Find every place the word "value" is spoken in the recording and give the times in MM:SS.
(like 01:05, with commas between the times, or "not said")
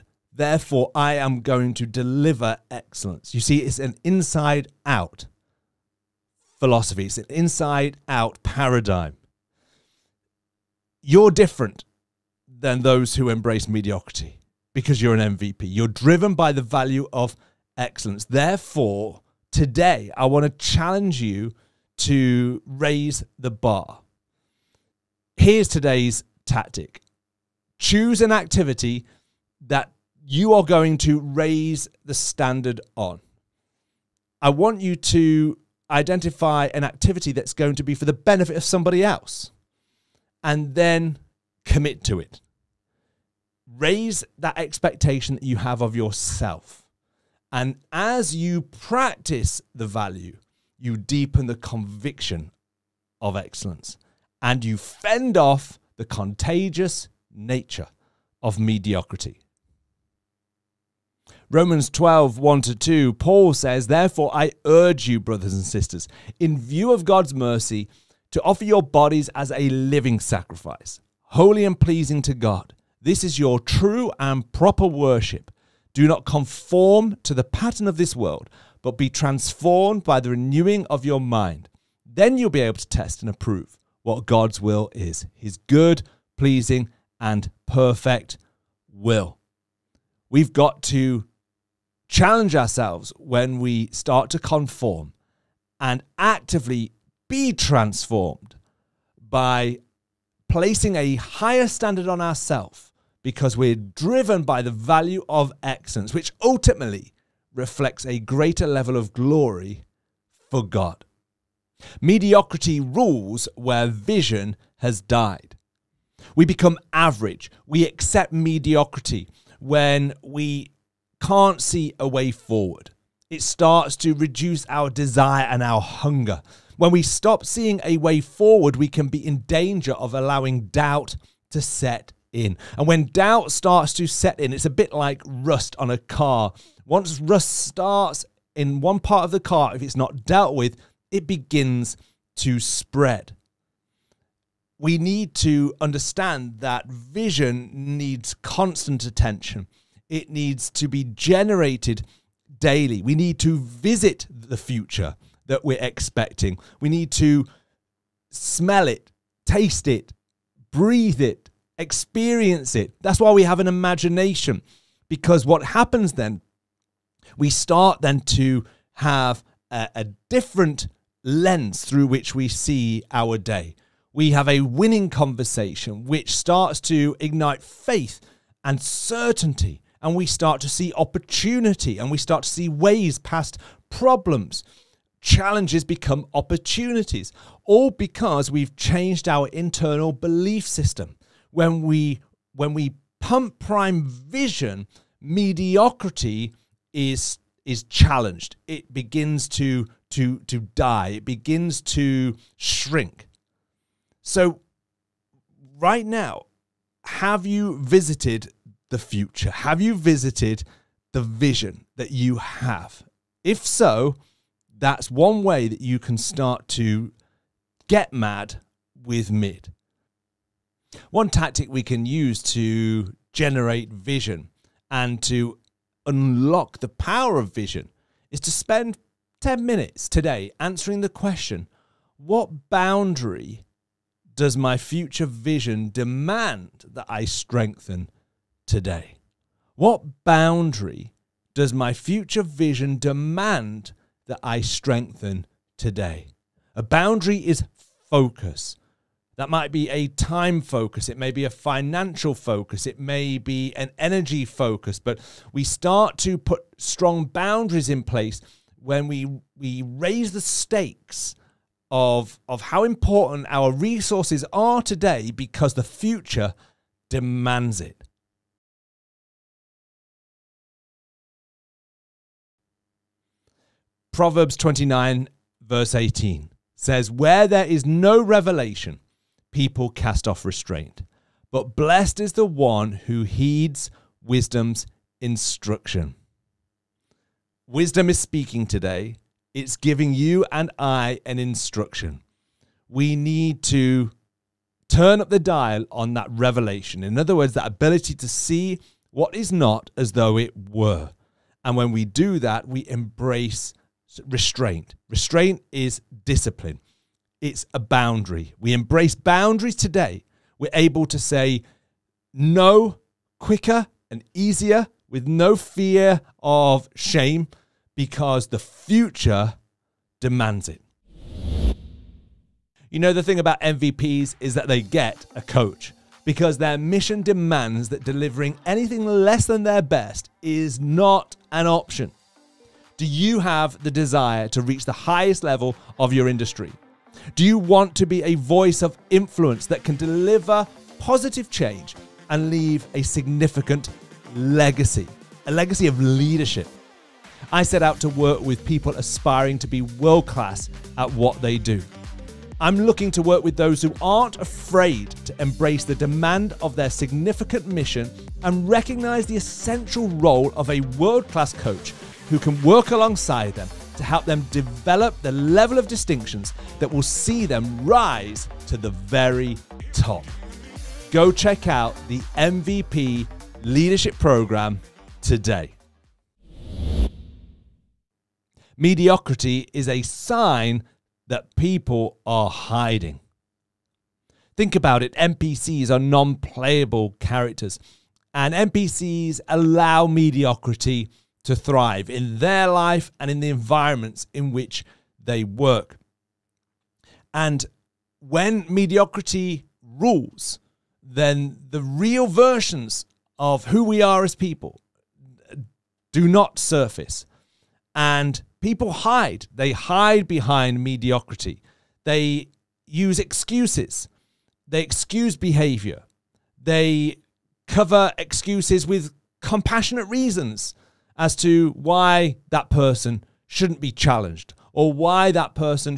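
00:16, 00:49, 01:44.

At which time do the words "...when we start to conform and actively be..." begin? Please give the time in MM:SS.
01:33.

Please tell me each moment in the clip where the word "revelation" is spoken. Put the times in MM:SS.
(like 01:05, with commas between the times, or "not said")
04:38, 04:56.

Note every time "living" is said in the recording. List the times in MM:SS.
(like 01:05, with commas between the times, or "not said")
01:09.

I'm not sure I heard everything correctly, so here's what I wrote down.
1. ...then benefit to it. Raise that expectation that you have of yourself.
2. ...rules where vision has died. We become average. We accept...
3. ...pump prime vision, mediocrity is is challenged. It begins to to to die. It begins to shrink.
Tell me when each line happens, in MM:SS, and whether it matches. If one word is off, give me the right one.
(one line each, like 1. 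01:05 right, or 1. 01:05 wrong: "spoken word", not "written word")
1. 00:40 wrong: "commit", not "benefit"
2. 01:52 right
3. 03:13 right.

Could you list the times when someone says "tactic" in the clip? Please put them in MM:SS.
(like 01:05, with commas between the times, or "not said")
00:26, 03:41.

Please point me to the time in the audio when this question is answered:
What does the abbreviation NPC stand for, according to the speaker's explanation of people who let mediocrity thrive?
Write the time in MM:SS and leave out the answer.
06:25.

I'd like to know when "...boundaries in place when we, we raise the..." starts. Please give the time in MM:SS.
04:17.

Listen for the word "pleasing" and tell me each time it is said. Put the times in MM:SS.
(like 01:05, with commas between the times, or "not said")
01:11, 01:26.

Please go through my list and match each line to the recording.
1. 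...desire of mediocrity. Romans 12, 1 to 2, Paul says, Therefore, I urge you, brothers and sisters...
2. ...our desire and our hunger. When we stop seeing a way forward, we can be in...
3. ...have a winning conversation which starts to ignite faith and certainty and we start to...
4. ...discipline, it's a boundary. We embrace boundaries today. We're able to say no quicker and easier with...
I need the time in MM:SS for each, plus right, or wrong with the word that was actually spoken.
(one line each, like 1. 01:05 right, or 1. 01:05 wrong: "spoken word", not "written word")
1. 00:57 wrong: "nature", not "desire"
2. 02:04 right
3. 02:54 right
4. 05:06 right.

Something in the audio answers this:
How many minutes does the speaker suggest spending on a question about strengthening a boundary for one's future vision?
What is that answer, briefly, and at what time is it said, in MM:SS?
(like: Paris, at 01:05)
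10, at 03:49.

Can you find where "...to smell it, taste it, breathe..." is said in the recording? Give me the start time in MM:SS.
02:37.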